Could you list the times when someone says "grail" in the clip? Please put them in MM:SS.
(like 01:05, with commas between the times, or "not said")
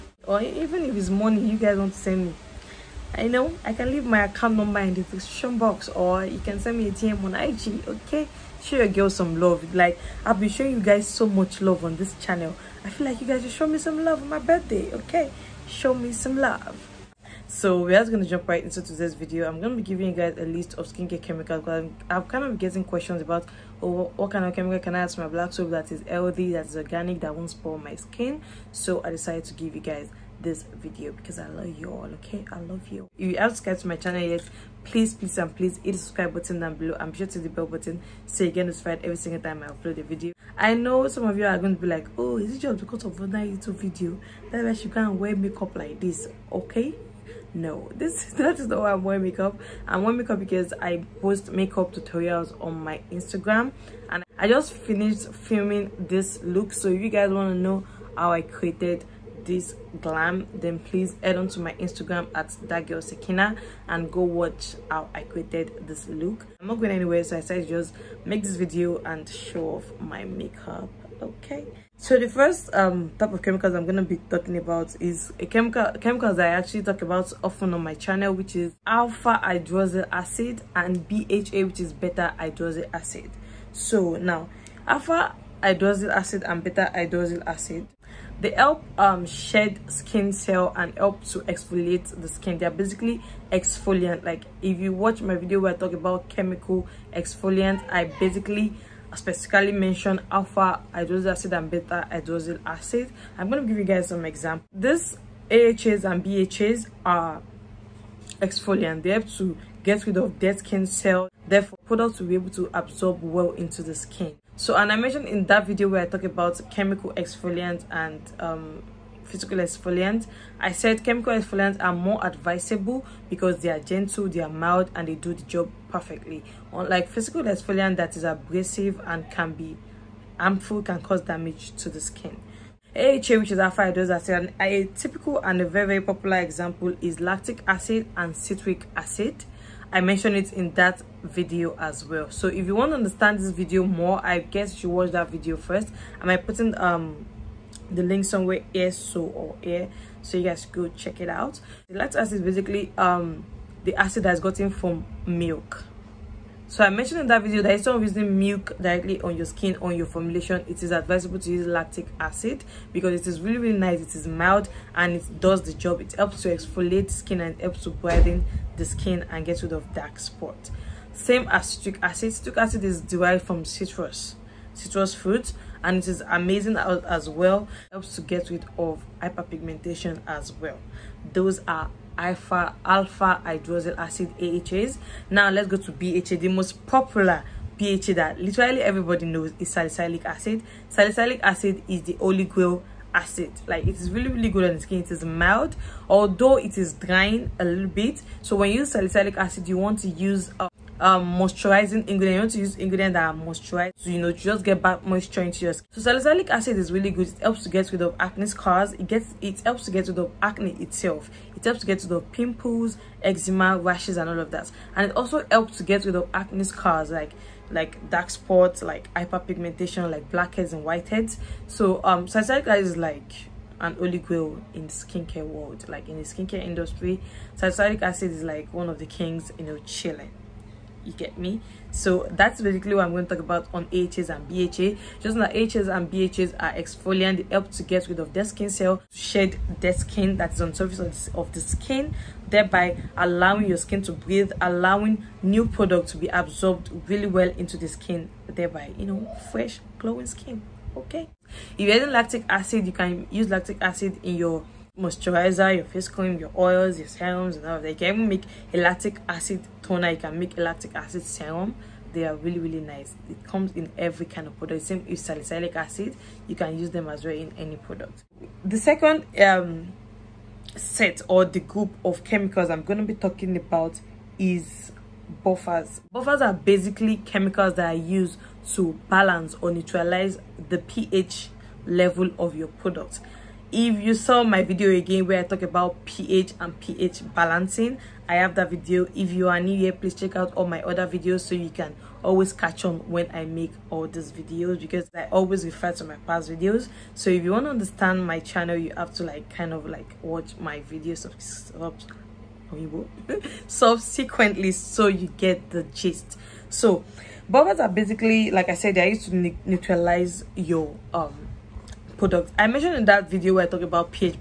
03:12, 03:44.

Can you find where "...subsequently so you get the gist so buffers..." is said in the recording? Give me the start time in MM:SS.
05:03.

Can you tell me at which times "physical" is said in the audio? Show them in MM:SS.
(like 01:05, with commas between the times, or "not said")
01:59, 02:07.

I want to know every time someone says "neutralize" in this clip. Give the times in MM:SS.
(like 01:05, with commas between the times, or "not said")
04:39, 05:09.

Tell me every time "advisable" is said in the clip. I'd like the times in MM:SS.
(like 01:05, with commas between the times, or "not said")
02:02, 02:40.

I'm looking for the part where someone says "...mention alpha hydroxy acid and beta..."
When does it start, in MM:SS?
01:39.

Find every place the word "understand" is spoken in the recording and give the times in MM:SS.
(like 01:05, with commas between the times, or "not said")
02:22, 04:57.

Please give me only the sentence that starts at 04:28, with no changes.
The second um, set or the group of chemicals I'm going to be talking about is buffers.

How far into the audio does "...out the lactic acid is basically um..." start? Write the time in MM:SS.
02:31.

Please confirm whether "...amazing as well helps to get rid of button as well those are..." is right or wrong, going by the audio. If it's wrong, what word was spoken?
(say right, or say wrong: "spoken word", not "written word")
wrong: "hyperpigmentation", not "button".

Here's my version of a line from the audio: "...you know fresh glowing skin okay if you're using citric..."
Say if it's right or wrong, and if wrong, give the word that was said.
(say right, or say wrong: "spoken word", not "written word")
wrong: "lactic", not "citric".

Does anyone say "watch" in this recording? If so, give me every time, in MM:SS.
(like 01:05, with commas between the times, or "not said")
01:04, 01:34, 02:24, 05:00.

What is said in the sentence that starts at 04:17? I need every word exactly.
You can even make a lactic acid toner, you can make a lactic acid serum.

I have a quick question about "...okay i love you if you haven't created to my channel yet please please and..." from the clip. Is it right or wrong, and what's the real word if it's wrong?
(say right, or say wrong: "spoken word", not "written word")
wrong: "subscribed", not "created".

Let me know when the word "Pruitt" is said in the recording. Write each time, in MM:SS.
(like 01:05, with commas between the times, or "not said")
not said.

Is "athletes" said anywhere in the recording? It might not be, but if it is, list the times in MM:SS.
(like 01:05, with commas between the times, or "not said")
not said.